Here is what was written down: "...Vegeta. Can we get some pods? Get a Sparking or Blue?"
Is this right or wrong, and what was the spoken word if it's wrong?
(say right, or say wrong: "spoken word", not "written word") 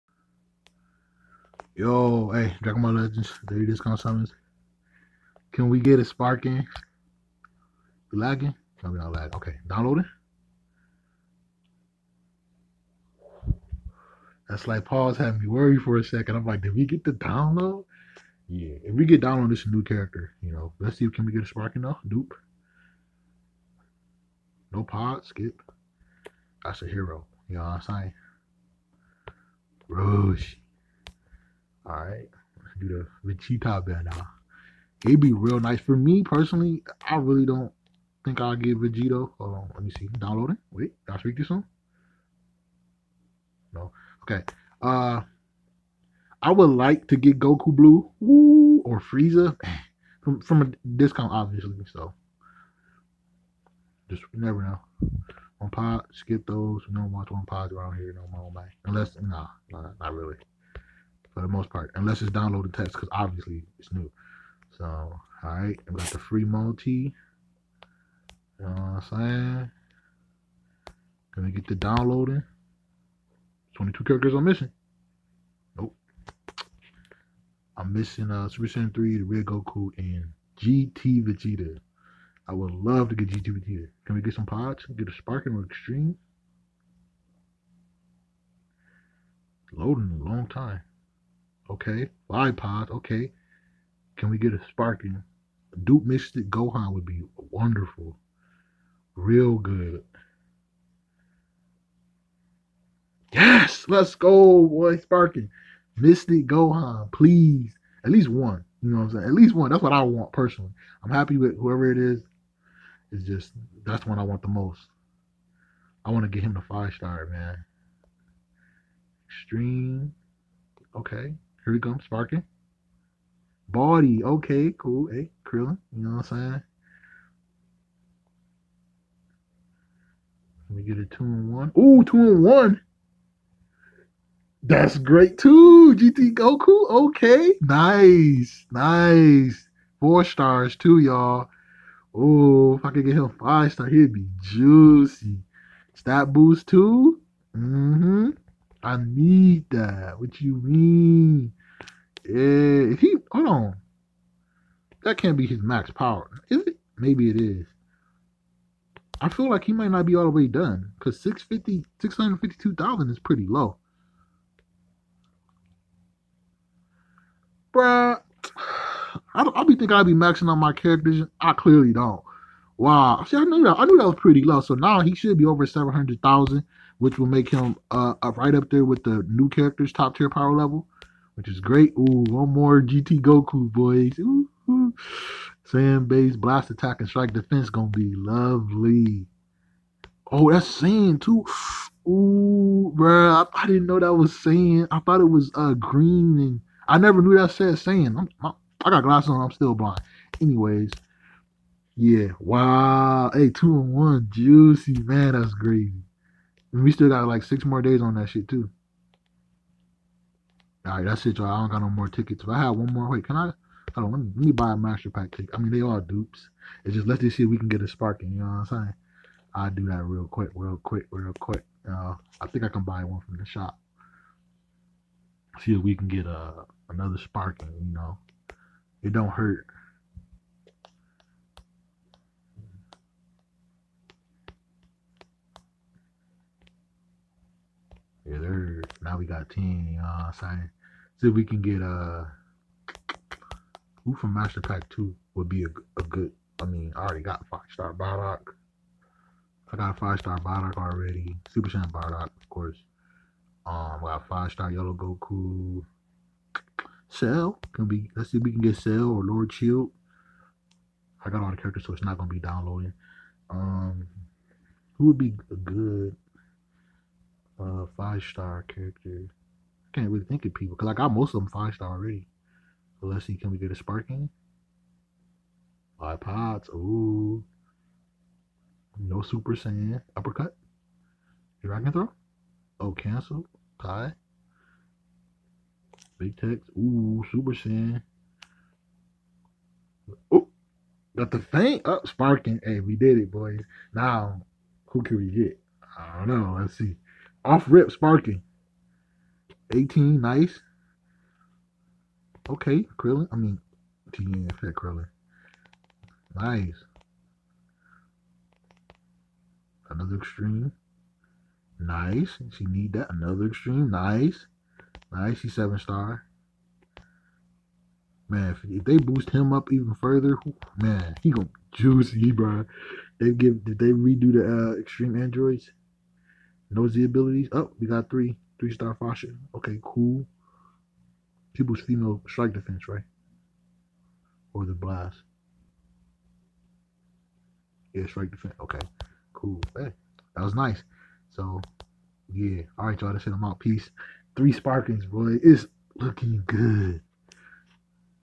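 wrong: "Extreme", not "Blue".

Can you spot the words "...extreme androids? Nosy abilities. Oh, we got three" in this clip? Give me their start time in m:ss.
5:24.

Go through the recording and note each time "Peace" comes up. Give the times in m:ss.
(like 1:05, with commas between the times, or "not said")
5:43.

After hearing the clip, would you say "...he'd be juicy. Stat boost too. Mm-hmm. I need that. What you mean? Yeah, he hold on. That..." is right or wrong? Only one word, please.
right.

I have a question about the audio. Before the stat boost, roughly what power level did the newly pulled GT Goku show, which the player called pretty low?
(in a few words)
652,000.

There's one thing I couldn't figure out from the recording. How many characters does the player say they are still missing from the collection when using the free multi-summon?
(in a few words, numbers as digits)
22.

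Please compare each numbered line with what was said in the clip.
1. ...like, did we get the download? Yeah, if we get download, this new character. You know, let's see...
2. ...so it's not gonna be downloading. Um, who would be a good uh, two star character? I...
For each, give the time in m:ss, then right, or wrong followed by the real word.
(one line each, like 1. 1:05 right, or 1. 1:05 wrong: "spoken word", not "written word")
1. 0:16 right
2. 4:21 wrong: "five", not "two".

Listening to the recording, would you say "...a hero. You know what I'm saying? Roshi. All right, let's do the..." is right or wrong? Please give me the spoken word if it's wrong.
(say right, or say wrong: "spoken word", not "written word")
right.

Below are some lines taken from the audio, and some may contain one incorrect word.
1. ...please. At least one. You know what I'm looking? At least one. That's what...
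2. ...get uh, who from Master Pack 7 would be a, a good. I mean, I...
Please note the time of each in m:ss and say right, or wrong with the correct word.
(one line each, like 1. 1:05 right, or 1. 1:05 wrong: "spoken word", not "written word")
1. 1:47 wrong: "saying", not "looking"
2. 4:01 wrong: "2", not "7".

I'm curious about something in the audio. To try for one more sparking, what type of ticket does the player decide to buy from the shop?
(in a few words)
master pack ticket.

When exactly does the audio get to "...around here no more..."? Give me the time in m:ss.
0:57.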